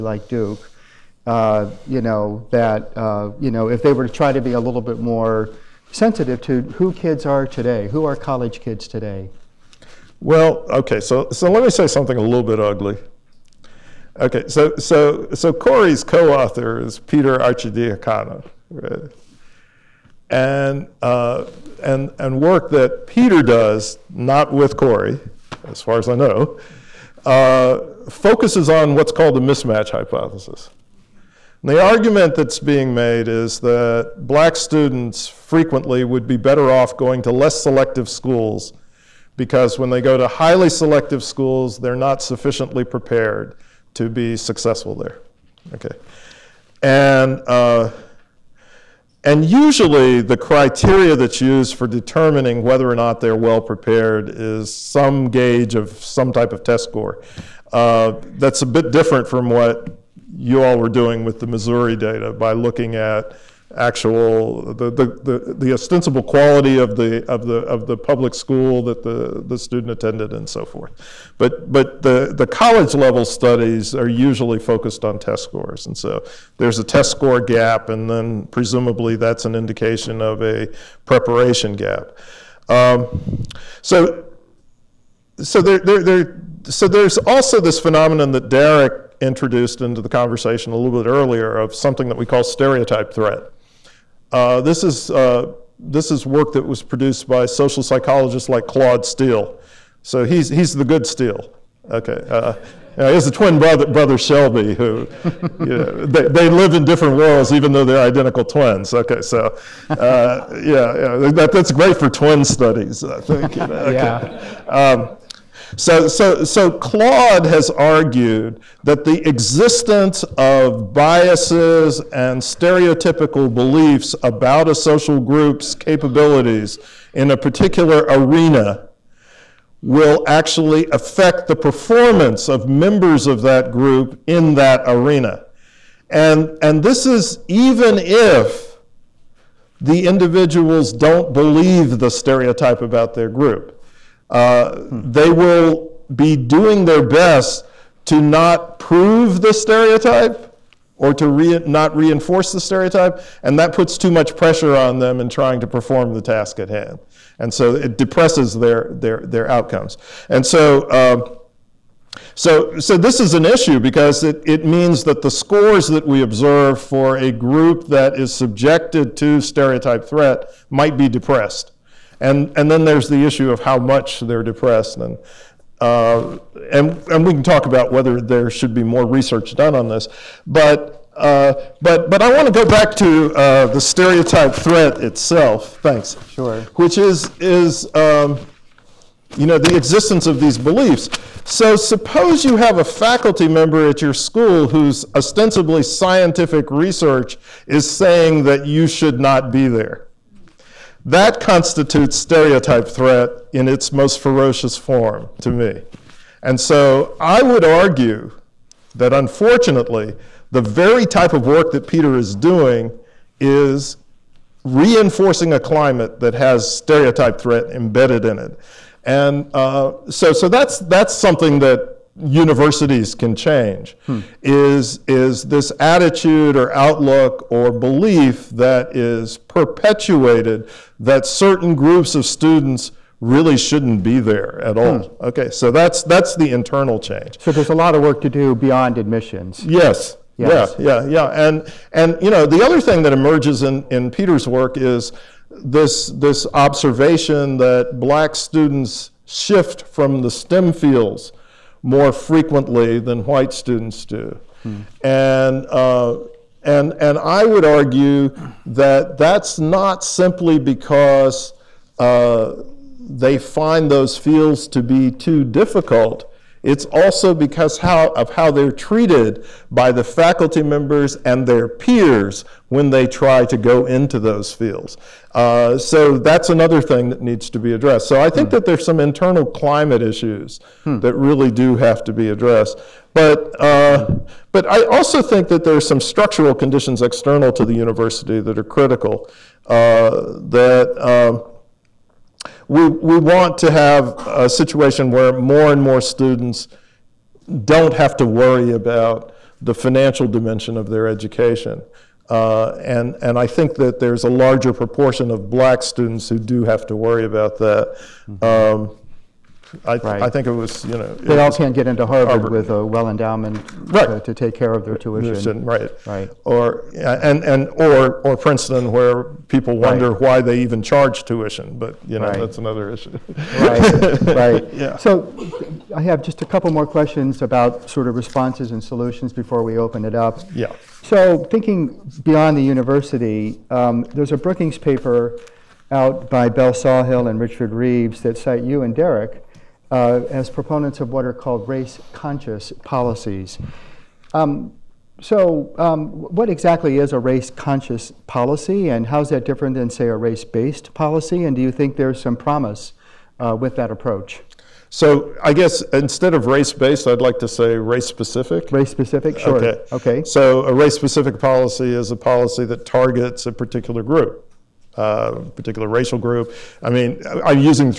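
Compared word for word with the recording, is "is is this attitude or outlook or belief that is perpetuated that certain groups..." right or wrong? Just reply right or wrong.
right.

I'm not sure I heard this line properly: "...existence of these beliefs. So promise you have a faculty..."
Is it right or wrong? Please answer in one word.
wrong.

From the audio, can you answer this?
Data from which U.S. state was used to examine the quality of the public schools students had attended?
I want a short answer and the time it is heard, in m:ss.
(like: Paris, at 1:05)
Missouri, at 1:01.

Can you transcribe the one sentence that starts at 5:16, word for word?
Or, and, and, or, or Princeton where people wonder why they even charge tuition, but, you know, Right.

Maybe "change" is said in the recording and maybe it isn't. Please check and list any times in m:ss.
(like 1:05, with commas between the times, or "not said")
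3:43, 3:56.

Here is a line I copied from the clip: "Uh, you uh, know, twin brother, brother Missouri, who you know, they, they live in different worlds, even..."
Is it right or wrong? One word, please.
wrong.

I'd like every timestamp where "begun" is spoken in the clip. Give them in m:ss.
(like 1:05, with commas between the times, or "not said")
not said.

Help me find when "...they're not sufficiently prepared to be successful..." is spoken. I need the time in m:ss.
0:41.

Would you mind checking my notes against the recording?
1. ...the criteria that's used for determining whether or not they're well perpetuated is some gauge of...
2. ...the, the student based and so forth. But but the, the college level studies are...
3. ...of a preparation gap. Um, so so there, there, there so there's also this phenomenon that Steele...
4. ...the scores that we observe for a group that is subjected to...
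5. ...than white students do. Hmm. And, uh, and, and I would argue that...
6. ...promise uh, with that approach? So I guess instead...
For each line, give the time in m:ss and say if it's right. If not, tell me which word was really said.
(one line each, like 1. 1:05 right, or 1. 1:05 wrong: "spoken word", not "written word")
1. 0:50 wrong: "prepared", not "perpetuated"
2. 1:09 wrong: "attended", not "based"
3. 1:20 wrong: "Darrick", not "Steele"
4. 2:45 right
5. 4:12 right
6. 5:52 right.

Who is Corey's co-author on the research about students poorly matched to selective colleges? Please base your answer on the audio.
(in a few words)
Peter Arcidiacono.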